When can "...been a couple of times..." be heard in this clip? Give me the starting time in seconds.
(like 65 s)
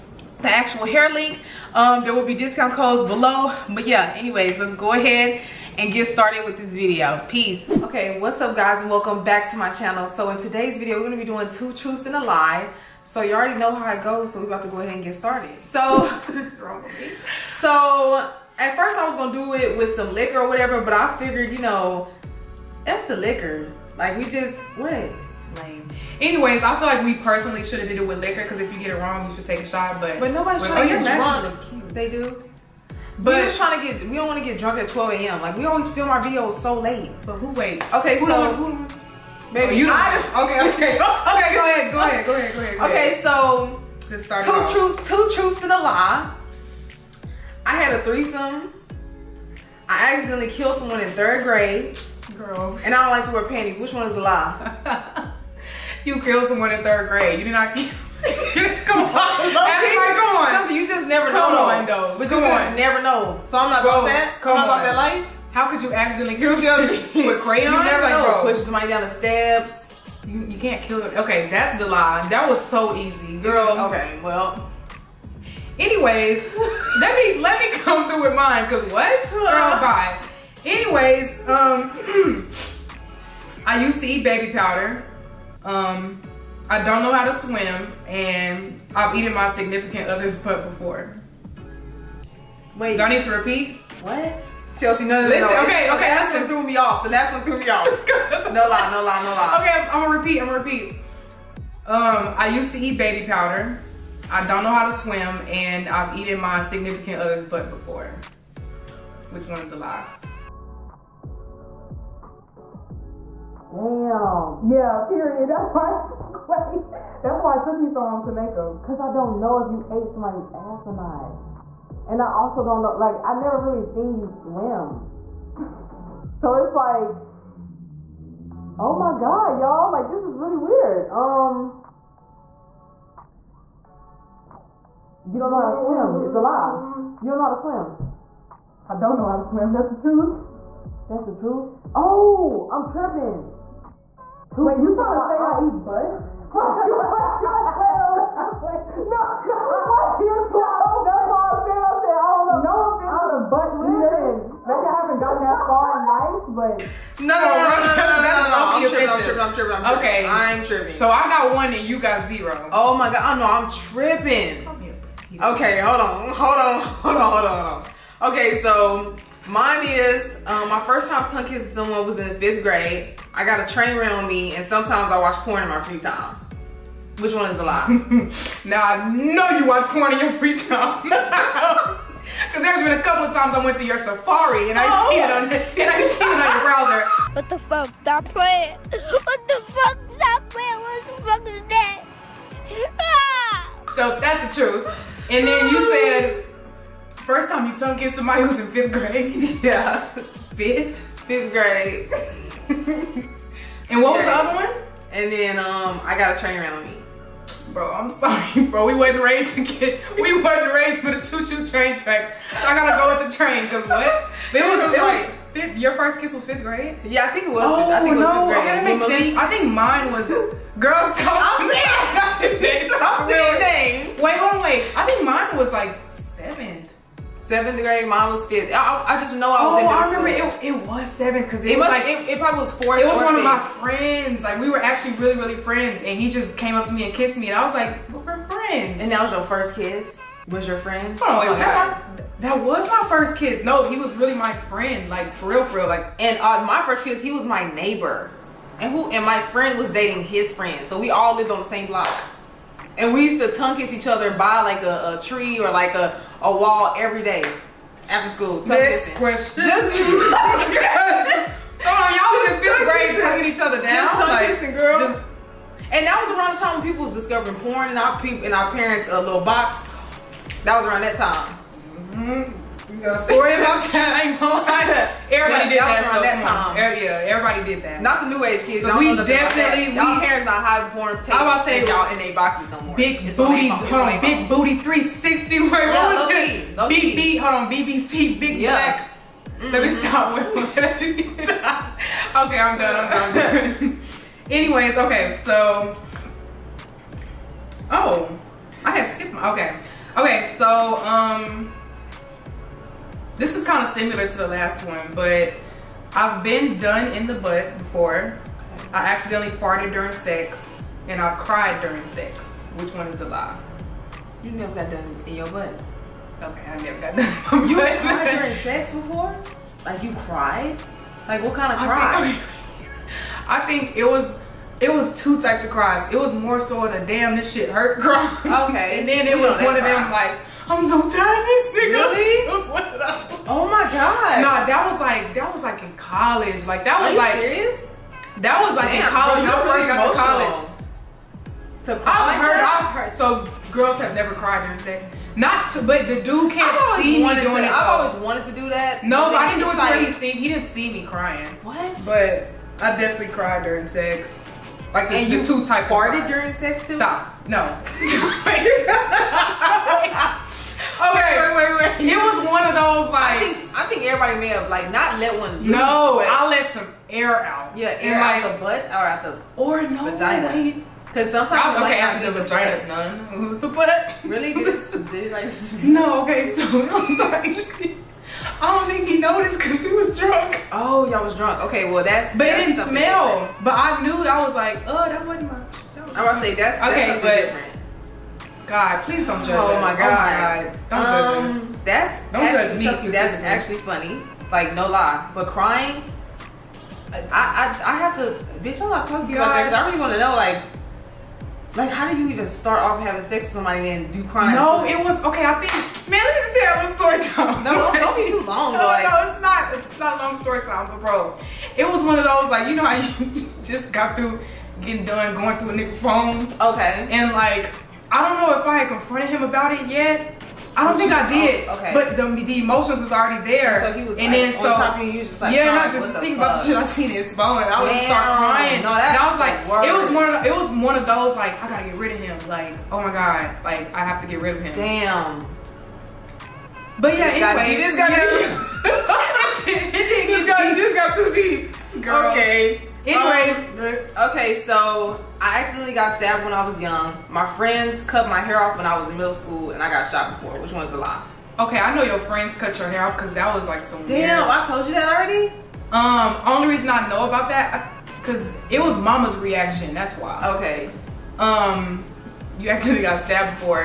182 s.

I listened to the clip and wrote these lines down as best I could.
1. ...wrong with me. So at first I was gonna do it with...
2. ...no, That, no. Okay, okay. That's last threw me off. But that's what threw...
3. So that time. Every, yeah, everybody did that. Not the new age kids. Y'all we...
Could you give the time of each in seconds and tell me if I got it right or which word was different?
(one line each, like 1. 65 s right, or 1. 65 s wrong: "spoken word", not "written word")
1. 16 s right
2. 95 s wrong: "Listen", not "That"
3. 276 s right.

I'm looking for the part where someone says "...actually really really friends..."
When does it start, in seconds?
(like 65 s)
234 s.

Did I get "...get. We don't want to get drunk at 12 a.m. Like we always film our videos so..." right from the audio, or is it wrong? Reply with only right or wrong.
right.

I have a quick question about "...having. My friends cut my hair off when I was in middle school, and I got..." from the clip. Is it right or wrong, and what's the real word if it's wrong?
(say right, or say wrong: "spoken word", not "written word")
wrong: "young", not "having".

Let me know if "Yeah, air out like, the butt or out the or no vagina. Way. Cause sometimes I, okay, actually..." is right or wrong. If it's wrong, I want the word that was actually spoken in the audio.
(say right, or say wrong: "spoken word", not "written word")
right.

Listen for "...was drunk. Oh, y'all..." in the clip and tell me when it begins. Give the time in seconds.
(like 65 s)
379 s.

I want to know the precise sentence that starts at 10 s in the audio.
So in today's video, we're gonna be doing two truths and a lie.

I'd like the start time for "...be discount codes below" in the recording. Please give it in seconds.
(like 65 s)
2 s.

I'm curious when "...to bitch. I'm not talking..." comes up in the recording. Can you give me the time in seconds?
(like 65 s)
398 s.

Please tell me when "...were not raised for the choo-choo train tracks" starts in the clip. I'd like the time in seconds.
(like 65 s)
210 s.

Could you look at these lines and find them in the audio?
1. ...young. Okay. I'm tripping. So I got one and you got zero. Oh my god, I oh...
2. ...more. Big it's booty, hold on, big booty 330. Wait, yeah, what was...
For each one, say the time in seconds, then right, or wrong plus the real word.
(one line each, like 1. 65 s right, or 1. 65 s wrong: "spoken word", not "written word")
1. 159 s wrong: "tripping", not "young"
2. 282 s wrong: "360", not "330".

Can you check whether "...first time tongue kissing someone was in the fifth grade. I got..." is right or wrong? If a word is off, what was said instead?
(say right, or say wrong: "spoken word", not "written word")
right.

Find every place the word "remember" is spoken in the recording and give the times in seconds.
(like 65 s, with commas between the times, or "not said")
230 s.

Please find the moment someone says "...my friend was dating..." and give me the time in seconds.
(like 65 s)
249 s.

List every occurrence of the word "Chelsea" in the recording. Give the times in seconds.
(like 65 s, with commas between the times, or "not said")
60 s, 94 s.